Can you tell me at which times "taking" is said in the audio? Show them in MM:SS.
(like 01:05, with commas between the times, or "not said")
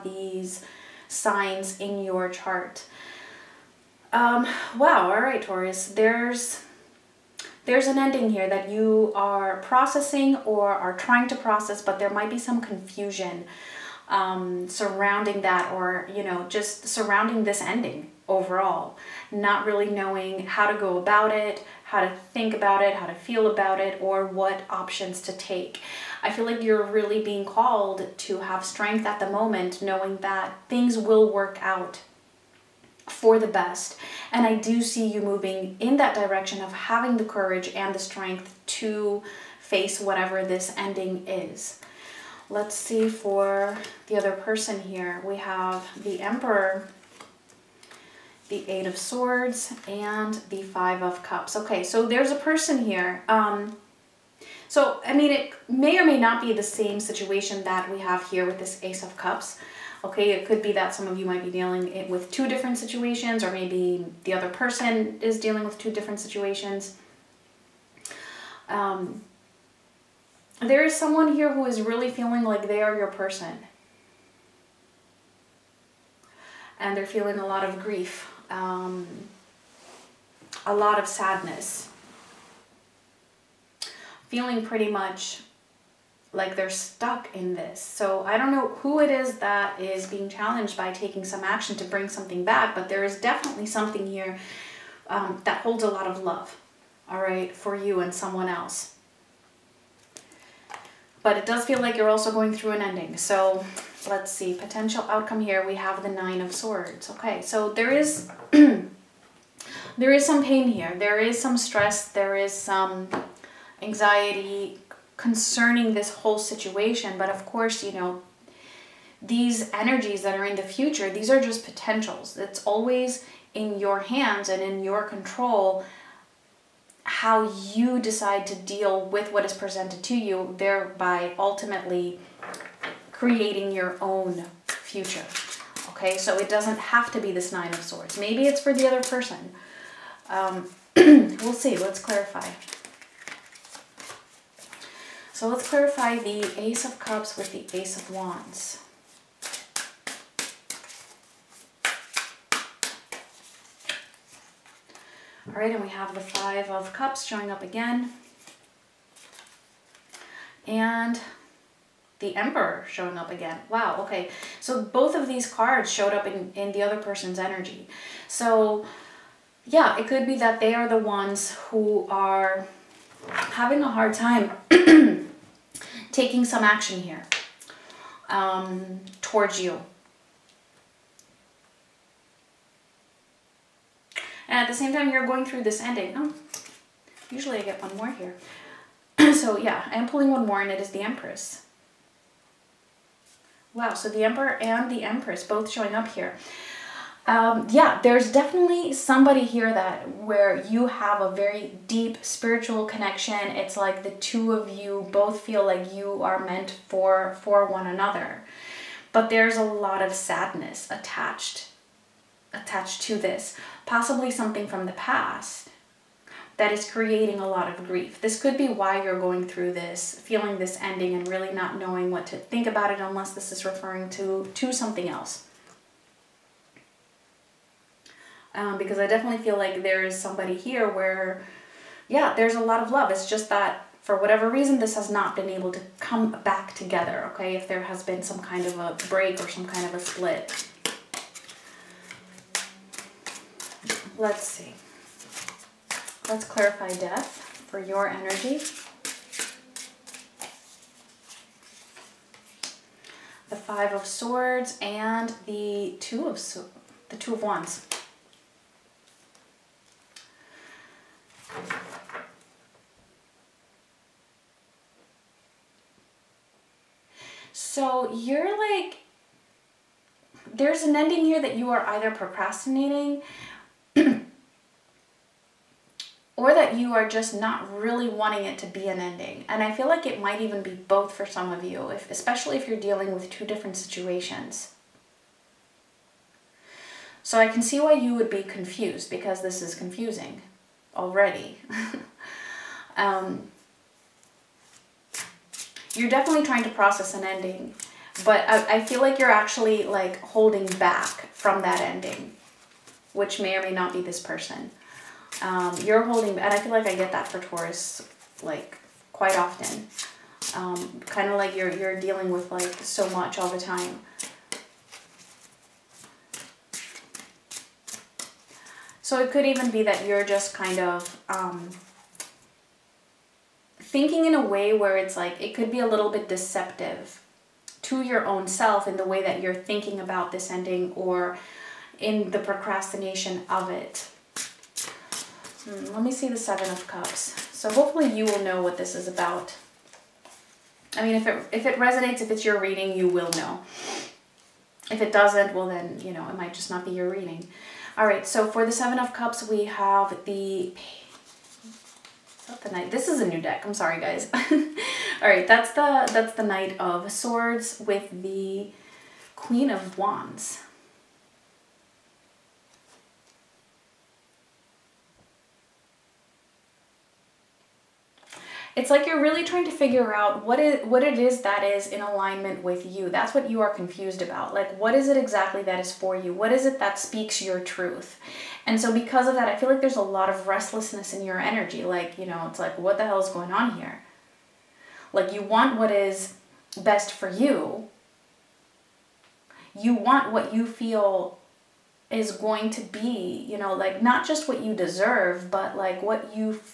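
01:30, 02:56.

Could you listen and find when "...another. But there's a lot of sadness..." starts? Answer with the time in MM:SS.
03:27.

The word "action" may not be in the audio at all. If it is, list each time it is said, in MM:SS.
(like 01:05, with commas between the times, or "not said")
01:31, 02:56.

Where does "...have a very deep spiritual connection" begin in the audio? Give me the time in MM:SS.
03:20.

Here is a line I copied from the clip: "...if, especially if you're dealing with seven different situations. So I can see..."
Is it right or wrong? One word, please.
wrong.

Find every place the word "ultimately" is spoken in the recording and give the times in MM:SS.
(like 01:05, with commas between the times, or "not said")
02:11.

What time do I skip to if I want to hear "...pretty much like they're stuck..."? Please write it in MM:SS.
01:24.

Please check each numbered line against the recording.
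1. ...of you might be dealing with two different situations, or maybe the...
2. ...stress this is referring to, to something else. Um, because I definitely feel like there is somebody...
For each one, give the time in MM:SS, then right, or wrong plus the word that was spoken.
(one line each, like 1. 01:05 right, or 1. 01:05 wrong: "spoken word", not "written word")
1. 01:01 right
2. 03:42 wrong: "unless", not "stress".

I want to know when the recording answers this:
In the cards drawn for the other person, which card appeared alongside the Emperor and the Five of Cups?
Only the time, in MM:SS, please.
00:48.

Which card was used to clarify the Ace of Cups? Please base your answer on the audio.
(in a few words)
Ace of Wands.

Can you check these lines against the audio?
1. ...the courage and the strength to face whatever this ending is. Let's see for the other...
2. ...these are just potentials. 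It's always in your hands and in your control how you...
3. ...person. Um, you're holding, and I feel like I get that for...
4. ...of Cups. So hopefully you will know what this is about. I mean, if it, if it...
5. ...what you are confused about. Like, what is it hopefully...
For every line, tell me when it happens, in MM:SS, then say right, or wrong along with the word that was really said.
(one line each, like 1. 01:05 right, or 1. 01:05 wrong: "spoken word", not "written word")
1. 00:37 right
2. 02:01 right
3. 05:04 right
4. 05:36 right
5. 06:13 wrong: "exactly", not "hopefully".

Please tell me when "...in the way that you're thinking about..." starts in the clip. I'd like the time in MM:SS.
05:28.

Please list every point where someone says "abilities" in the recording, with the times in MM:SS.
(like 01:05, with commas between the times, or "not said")
not said.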